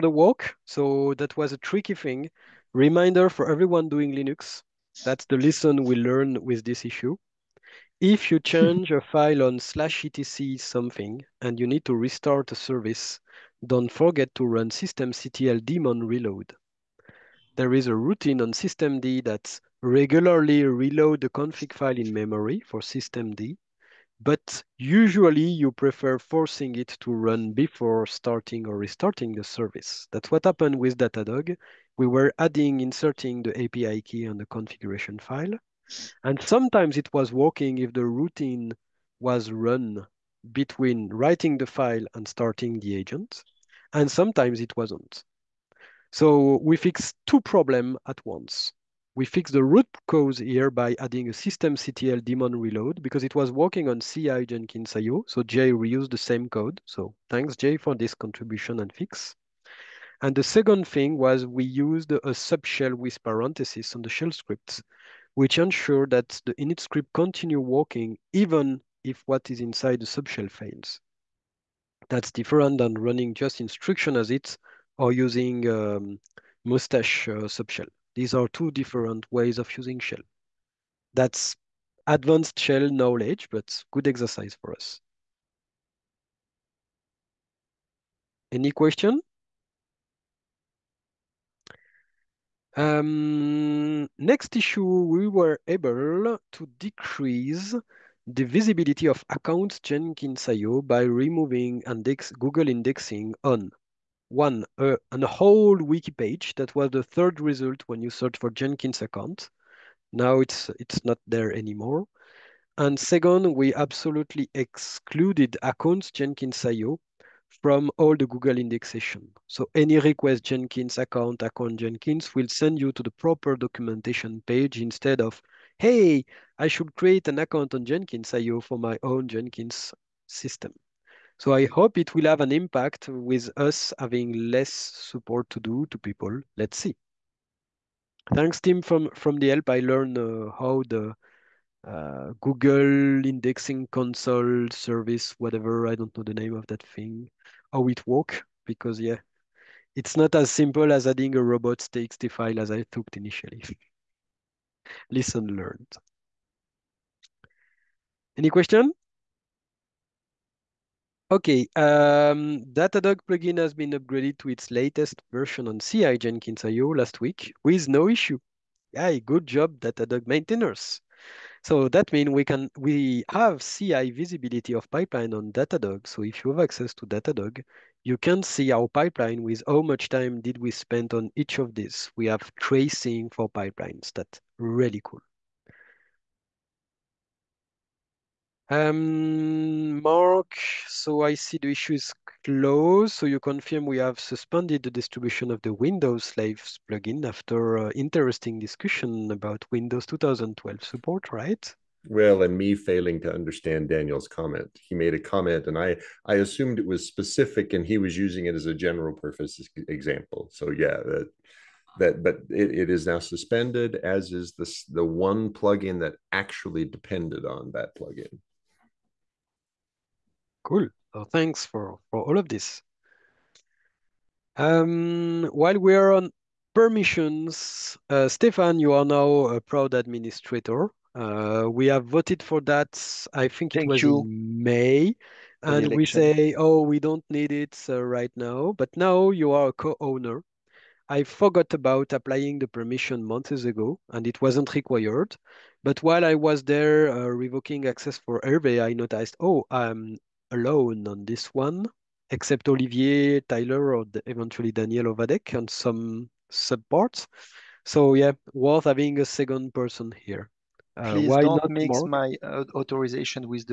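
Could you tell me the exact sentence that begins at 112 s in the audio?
And second, we absolutely excluded accounts Jenkins.io from all the Google indexation.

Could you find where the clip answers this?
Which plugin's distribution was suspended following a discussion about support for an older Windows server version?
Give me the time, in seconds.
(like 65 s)
195 s.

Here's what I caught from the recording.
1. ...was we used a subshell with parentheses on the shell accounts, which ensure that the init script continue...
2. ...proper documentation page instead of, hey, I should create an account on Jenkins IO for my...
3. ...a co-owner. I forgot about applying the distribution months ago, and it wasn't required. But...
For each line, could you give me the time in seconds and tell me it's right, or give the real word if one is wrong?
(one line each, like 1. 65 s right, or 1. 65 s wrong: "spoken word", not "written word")
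1. 61 s wrong: "scripts", not "accounts"
2. 123 s right
3. 239 s wrong: "permission", not "distribution".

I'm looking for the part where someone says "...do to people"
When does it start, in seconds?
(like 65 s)
135 s.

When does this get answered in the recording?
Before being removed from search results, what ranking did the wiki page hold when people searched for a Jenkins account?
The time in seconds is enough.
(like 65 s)
107 s.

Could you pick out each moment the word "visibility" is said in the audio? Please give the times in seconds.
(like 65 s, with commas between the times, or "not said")
98 s, 174 s.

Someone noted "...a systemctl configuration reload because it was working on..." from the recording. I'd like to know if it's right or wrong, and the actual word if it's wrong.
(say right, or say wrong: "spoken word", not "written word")
wrong: "daemon", not "configuration".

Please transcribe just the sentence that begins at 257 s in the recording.
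So yeah, worth having a second person here.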